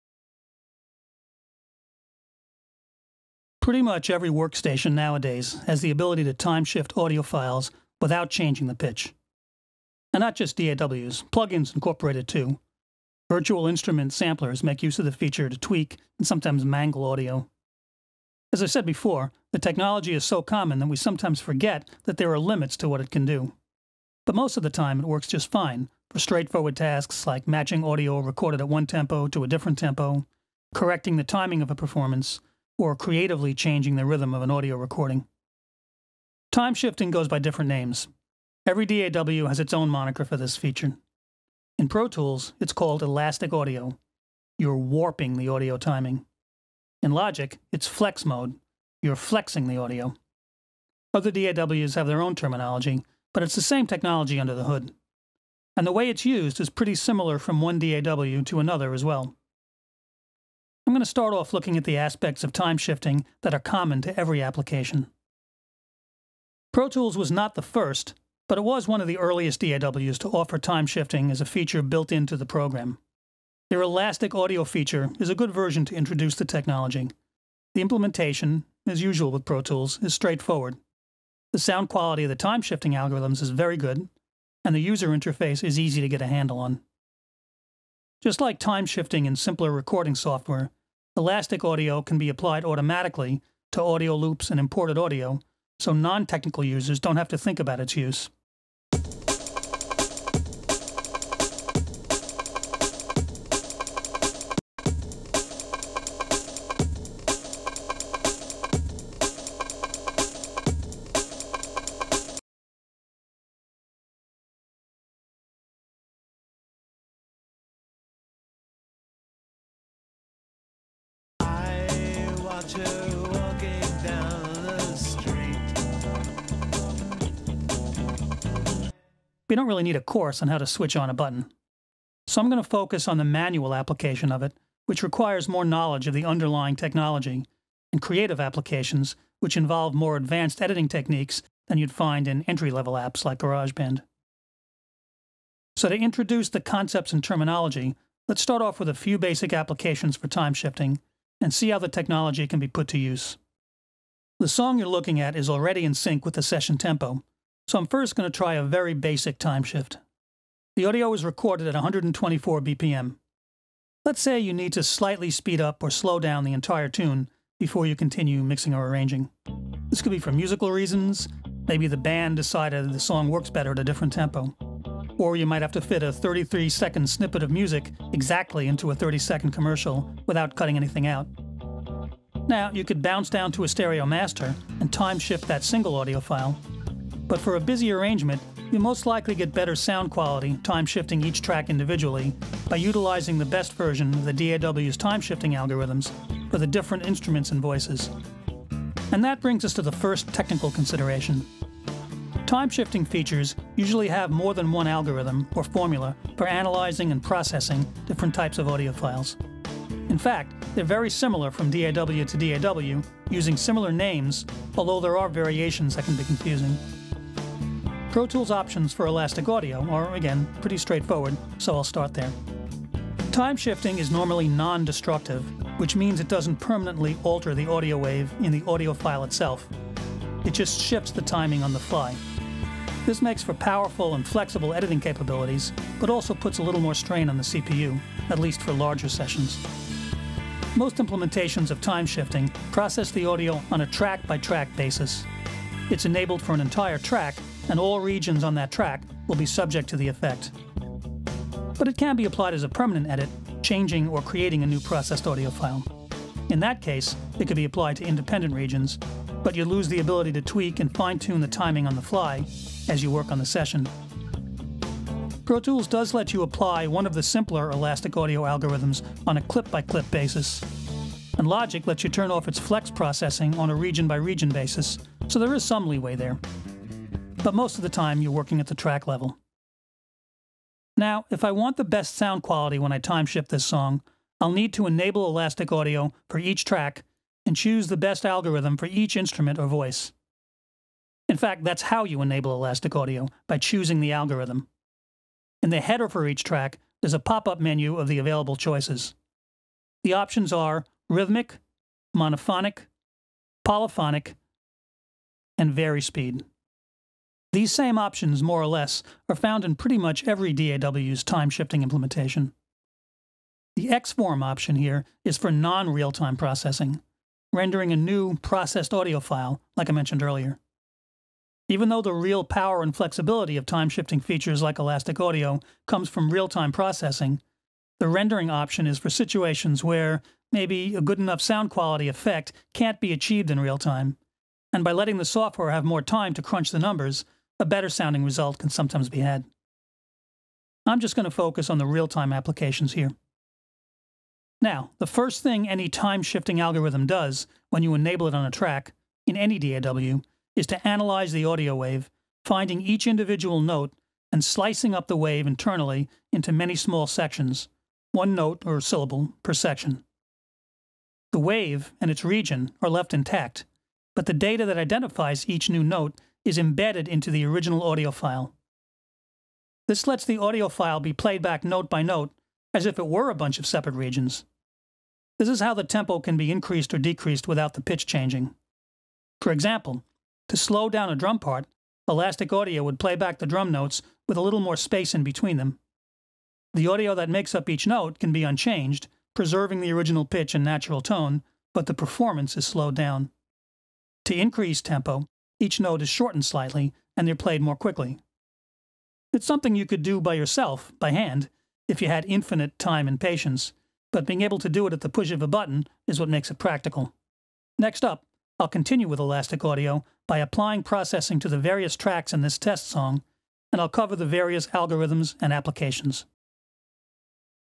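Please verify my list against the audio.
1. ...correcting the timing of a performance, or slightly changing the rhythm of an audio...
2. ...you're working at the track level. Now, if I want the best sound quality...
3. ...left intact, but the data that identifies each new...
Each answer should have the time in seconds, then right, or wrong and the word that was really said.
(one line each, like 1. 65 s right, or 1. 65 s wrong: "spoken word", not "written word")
1. 30 s wrong: "creatively", not "slightly"
2. 278 s right
3. 362 s right.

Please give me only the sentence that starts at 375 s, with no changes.
This is how the tempo can be increased or decreased without the pitch changing.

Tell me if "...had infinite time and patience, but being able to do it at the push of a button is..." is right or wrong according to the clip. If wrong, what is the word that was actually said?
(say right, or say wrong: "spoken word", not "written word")
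right.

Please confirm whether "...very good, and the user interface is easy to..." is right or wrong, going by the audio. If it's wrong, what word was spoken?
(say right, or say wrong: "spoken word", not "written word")
right.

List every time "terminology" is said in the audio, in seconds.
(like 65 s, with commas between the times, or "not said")
52 s, 147 s.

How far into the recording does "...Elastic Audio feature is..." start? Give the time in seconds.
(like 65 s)
73 s.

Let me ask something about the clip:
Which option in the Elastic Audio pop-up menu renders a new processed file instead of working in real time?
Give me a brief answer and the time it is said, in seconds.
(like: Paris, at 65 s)
XForm, at 313 s.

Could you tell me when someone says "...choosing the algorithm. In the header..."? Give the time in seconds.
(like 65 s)
293 s.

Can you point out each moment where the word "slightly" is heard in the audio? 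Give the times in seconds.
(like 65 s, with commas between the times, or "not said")
164 s, 396 s.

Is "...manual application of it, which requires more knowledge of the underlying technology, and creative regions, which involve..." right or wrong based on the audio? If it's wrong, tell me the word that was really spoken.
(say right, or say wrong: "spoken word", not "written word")
wrong: "applications", not "regions".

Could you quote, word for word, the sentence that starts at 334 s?
And by letting the software have more time to crunch the numbers, a better sounding result can sometimes be had.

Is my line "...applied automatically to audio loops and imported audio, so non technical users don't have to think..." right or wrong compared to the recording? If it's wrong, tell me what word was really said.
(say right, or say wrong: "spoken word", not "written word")
right.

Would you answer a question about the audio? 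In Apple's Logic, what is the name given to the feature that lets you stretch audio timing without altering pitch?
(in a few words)
Flex mode.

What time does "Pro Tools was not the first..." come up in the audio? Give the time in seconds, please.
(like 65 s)
66 s.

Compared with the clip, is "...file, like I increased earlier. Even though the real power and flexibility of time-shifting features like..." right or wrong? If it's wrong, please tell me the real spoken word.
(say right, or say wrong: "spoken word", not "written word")
wrong: "mentioned", not "increased".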